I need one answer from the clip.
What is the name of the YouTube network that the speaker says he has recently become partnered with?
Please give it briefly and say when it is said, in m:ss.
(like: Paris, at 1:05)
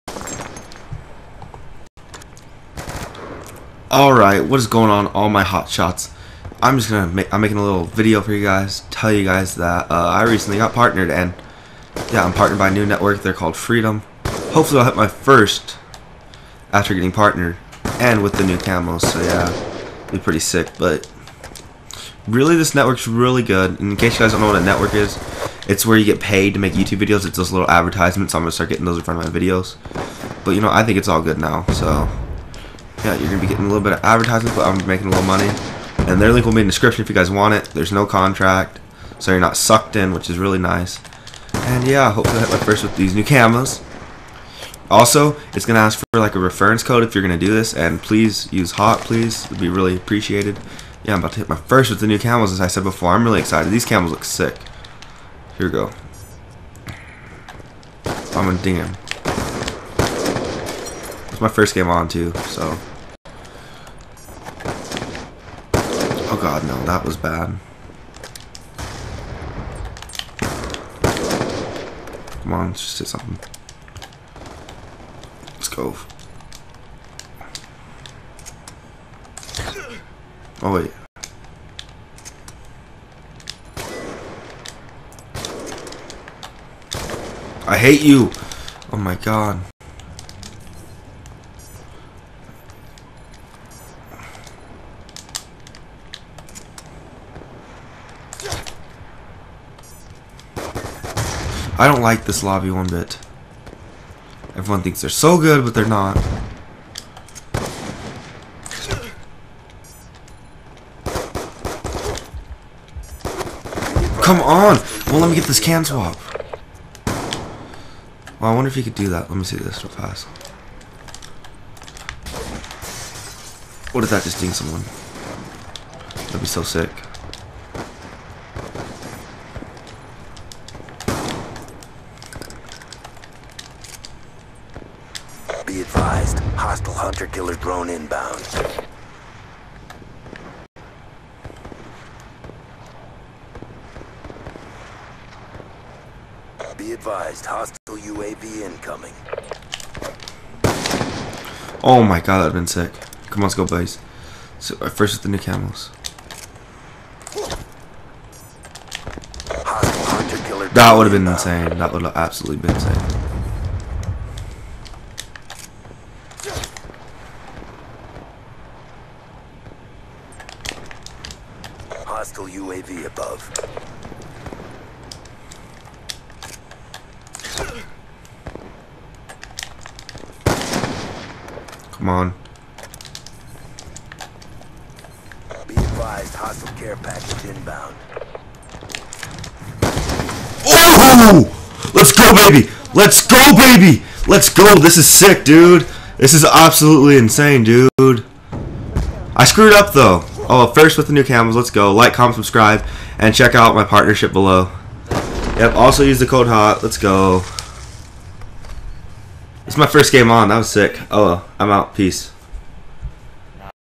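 Freedom, at 0:13.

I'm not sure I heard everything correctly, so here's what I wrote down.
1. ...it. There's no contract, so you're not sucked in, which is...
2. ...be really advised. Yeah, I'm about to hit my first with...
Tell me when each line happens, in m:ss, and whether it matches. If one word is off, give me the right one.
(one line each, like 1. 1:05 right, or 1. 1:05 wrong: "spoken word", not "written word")
1. 0:37 right
2. 0:49 wrong: "appreciated", not "advised".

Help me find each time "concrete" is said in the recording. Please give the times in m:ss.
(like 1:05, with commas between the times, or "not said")
not said.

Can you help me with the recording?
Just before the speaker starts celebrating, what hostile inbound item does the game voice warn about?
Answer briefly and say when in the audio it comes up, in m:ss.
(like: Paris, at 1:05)
Care package, at 3:06.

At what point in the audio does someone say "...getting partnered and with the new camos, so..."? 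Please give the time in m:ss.
0:16.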